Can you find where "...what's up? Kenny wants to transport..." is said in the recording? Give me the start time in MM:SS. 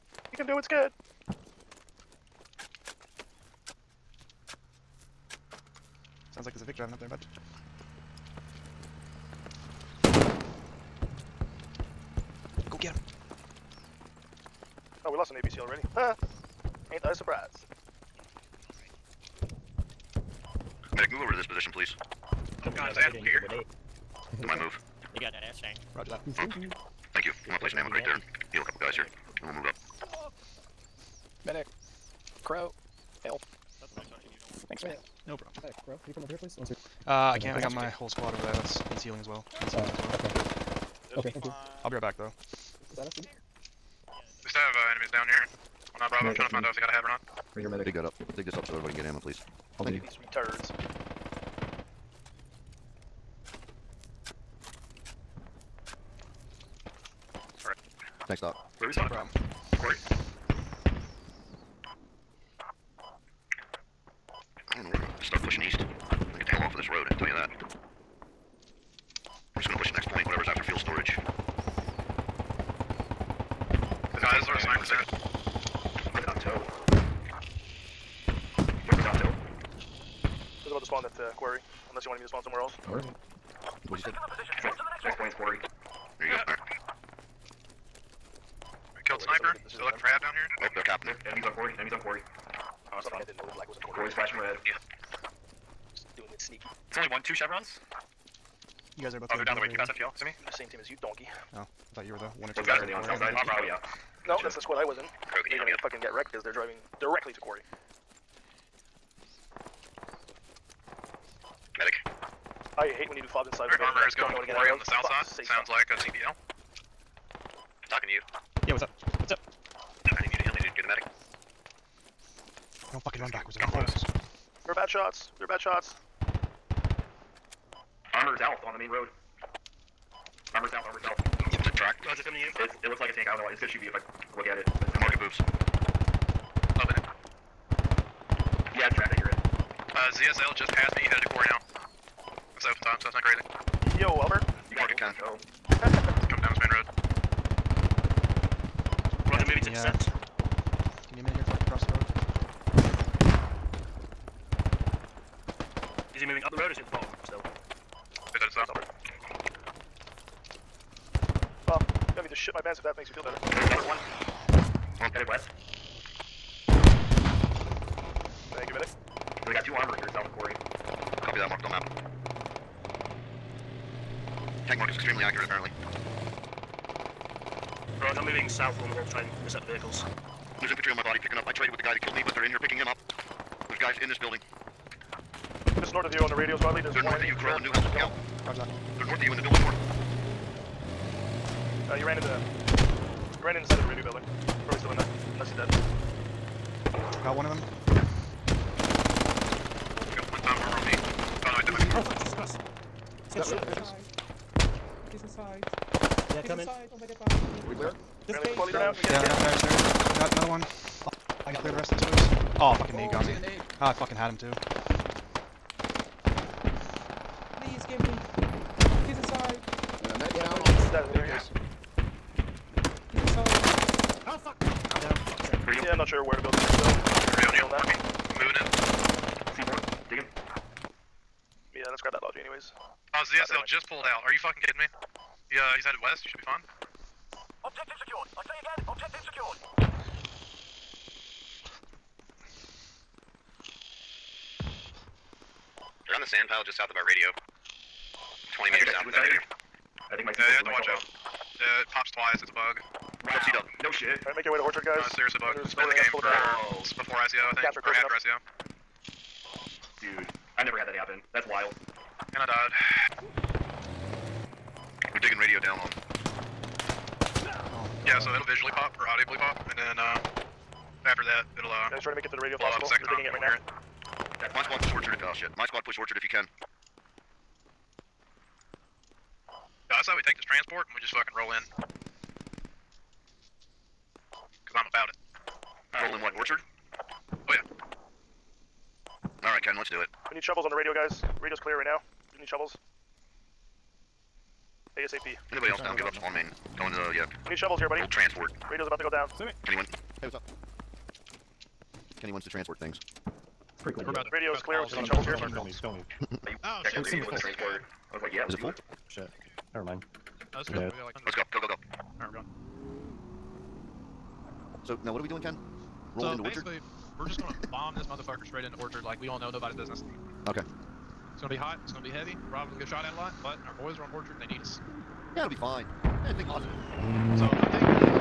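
05:00.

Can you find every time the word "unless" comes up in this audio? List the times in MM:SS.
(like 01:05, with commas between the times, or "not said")
01:21, 03:15.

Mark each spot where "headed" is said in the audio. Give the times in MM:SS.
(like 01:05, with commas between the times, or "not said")
02:21, 02:38, 02:45, 03:55.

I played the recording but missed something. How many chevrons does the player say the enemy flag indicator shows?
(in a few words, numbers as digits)
2.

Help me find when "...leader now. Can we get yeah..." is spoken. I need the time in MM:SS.
03:28.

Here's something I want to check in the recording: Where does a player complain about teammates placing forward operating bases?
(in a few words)
a building.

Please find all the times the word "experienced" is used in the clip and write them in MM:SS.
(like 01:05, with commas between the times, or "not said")
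not said.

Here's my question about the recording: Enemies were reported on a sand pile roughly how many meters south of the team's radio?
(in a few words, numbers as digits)
20.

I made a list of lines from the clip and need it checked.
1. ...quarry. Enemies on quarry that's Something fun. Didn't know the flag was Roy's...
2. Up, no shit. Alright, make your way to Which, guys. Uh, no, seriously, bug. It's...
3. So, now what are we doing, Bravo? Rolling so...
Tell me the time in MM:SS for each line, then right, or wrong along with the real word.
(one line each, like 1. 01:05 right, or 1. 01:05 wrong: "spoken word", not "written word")
1. 01:31 right
2. 04:13 wrong: "Orchard", not "Which"
3. 05:14 wrong: "Ken", not "Bravo".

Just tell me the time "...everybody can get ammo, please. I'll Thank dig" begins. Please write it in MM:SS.
00:48.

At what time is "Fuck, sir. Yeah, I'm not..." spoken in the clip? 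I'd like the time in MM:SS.
03:45.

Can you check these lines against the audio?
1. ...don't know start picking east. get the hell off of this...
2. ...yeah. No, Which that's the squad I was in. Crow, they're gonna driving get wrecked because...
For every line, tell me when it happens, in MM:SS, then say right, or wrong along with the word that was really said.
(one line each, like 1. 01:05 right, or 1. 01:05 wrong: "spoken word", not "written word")
1. 01:04 wrong: "pushing", not "picking"
2. 01:43 wrong: "fucking", not "driving".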